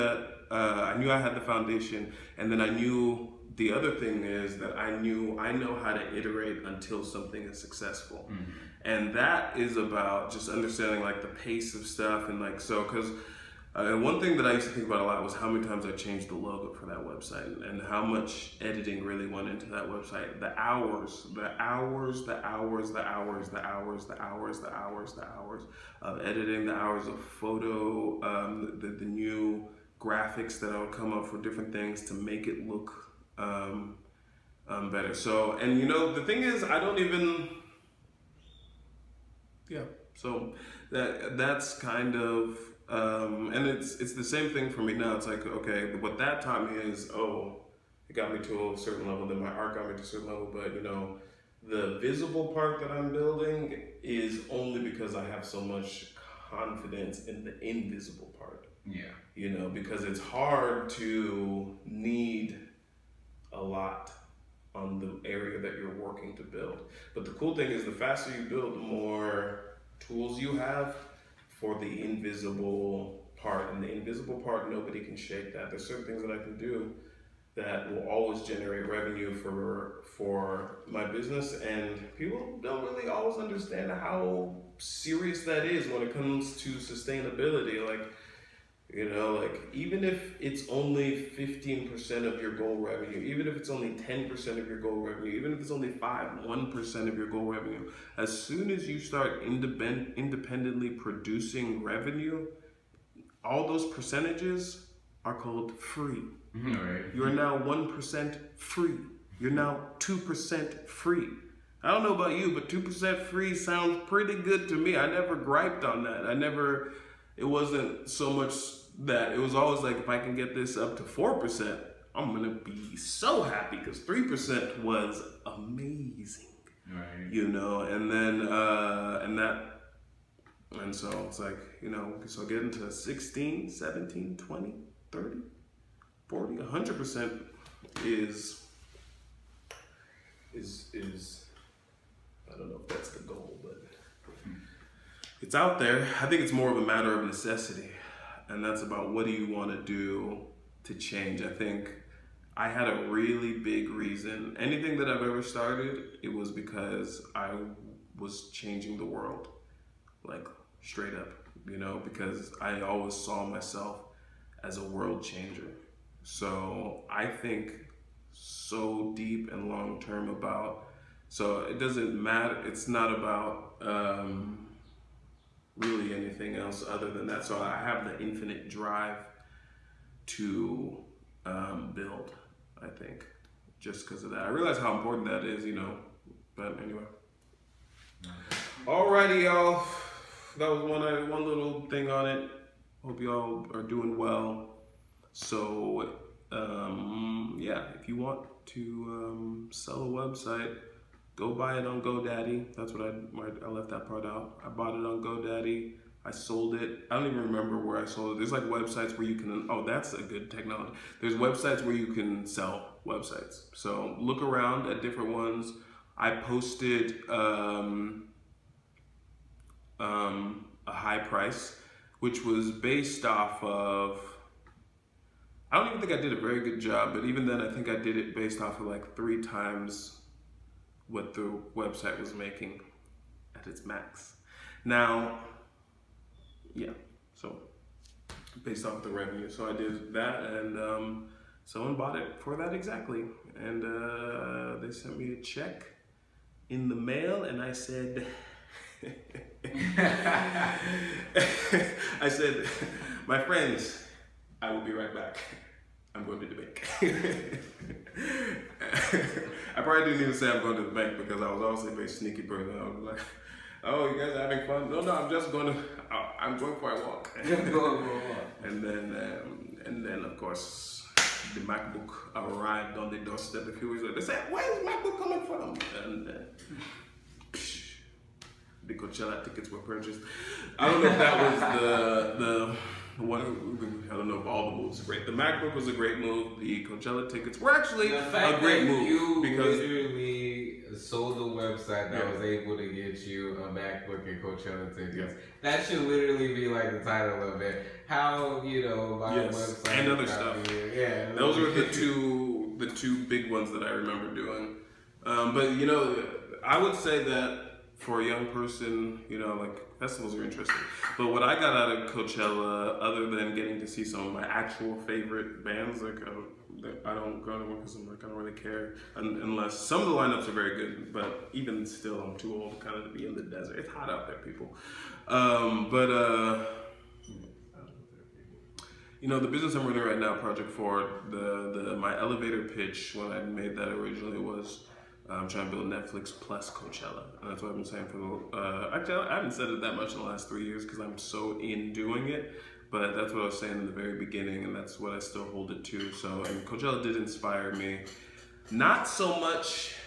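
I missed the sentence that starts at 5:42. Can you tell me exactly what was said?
But that's what I was saying in the very beginning, and that's what I still hold it to.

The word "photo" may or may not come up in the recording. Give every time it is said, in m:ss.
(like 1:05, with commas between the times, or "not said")
0:27.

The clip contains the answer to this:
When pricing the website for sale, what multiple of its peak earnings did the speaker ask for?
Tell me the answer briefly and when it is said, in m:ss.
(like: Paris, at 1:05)
3 times, at 3:49.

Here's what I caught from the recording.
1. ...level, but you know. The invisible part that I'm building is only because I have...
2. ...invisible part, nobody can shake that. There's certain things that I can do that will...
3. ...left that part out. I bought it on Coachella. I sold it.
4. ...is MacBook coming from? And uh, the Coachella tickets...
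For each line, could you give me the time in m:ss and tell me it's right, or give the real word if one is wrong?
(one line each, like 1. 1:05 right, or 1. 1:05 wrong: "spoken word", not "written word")
1. 0:50 wrong: "visible", not "invisible"
2. 1:13 right
3. 3:23 wrong: "GoDaddy", not "Coachella"
4. 4:34 right.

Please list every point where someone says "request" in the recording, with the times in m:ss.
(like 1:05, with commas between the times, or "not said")
not said.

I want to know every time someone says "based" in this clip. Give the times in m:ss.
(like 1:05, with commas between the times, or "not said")
3:42, 3:48, 3:58.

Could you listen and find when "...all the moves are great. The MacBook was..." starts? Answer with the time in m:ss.
4:44.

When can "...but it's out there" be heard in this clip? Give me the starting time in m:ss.
2:23.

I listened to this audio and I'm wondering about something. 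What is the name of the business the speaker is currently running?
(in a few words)
Project Forward.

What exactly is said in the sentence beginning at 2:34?
Anything that I've ever started, it was because I was changing the world.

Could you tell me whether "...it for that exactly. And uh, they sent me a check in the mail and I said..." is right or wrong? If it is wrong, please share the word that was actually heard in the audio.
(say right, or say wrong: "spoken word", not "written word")
right.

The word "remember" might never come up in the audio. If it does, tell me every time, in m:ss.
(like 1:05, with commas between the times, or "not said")
3:27, 5:03.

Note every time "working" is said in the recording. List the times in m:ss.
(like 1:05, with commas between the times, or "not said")
1:05.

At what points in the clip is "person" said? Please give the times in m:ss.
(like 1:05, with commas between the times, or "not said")
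4:22, 5:08.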